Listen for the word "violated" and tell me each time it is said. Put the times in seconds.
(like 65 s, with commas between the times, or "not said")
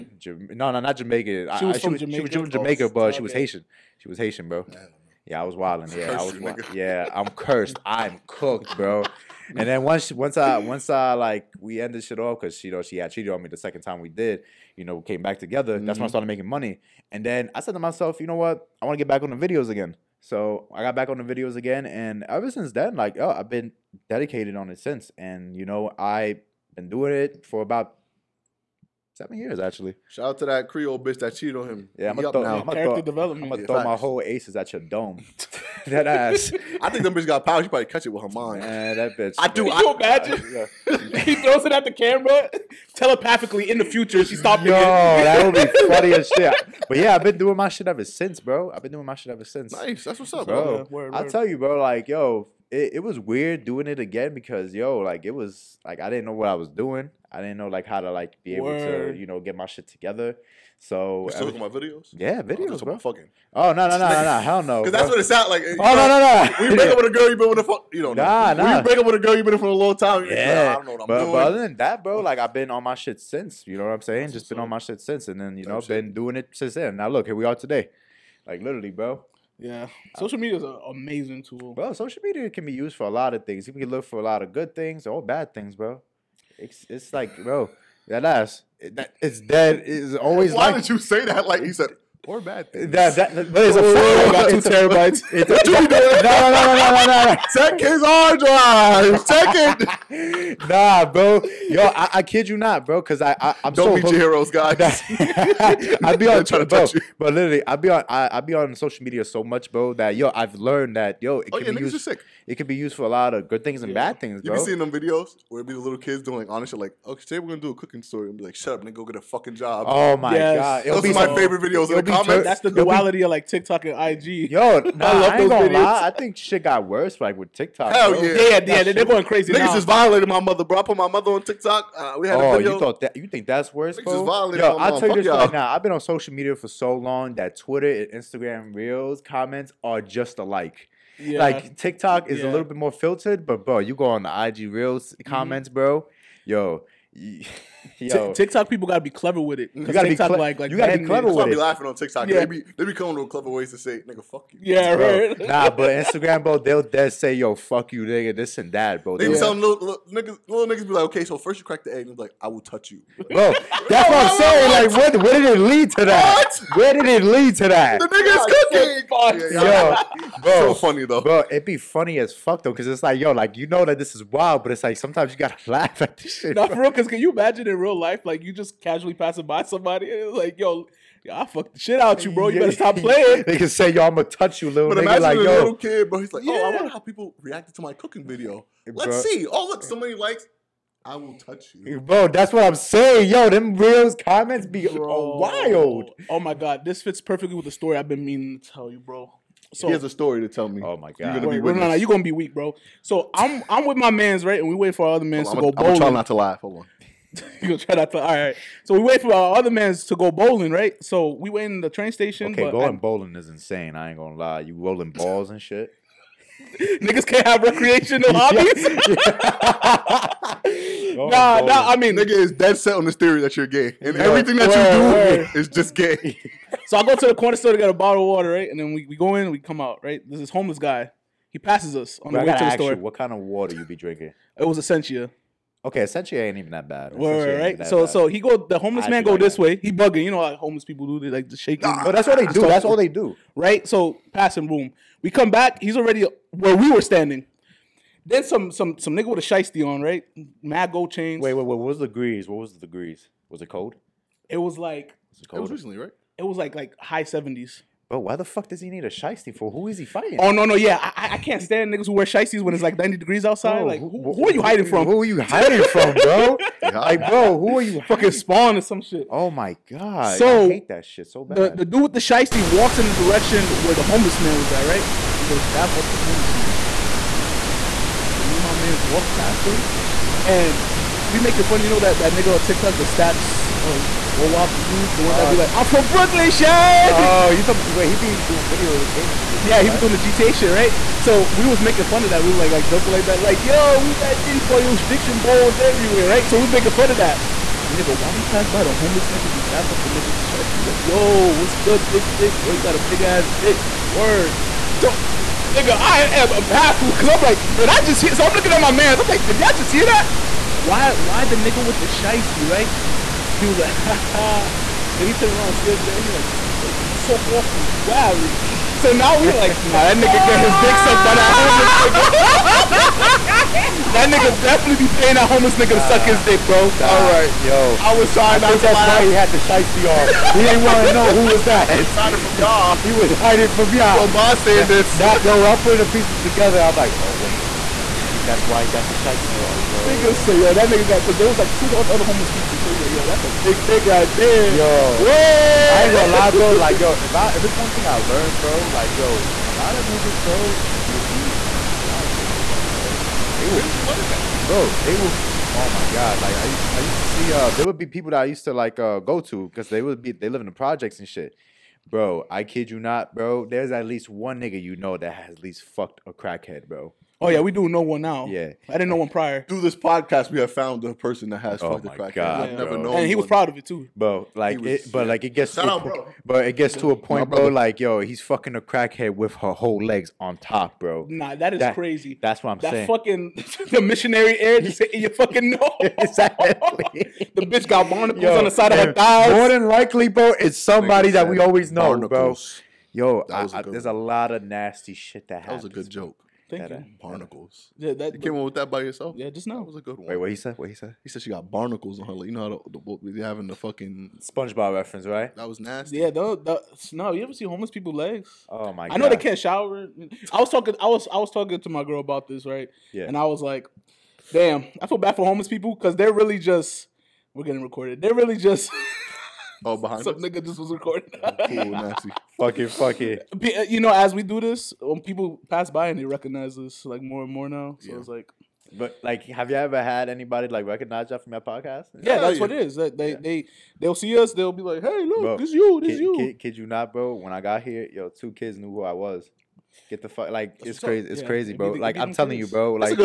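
129 s, 134 s.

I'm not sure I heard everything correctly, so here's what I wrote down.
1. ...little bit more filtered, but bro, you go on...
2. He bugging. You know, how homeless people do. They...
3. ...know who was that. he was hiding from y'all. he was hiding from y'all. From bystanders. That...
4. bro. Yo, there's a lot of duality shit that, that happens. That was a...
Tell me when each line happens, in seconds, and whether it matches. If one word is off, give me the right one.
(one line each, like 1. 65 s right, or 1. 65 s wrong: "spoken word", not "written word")
1. 142 s right
2. 239 s right
3. 331 s right
4. 393 s wrong: "nasty", not "duality".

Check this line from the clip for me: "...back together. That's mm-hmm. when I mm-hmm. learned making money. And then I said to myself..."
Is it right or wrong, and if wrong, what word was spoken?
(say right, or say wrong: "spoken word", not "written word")
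wrong: "started", not "learned".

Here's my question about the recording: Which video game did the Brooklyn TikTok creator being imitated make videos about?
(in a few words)
GTA.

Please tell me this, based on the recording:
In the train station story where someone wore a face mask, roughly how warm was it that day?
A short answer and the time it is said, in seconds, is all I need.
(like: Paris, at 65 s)
high seventies, at 256 s.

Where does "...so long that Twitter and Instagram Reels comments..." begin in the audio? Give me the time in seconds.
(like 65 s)
136 s.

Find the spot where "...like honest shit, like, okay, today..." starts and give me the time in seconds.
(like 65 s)
116 s.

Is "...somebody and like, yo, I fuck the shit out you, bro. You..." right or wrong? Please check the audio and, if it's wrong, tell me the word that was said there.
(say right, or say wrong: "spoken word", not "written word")
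right.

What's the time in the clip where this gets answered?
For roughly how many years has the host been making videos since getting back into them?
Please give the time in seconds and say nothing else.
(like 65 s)
29 s.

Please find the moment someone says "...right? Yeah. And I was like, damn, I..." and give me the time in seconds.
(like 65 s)
412 s.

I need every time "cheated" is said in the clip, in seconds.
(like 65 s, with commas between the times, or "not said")
13 s, 31 s.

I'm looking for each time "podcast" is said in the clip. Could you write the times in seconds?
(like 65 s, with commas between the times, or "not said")
369 s, 431 s.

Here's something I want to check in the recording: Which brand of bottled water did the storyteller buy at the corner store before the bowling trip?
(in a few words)
Essentia.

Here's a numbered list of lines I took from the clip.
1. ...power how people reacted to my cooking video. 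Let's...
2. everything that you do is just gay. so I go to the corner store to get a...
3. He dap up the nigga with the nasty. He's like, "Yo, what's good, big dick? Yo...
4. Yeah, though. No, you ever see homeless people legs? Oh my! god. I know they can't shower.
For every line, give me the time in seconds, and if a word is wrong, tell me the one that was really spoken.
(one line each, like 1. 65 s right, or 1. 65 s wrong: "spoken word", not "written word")
1. 186 s wrong: "wonder", not "power"
2. 224 s right
3. 299 s wrong: "shiesty", not "nasty"
4. 406 s right.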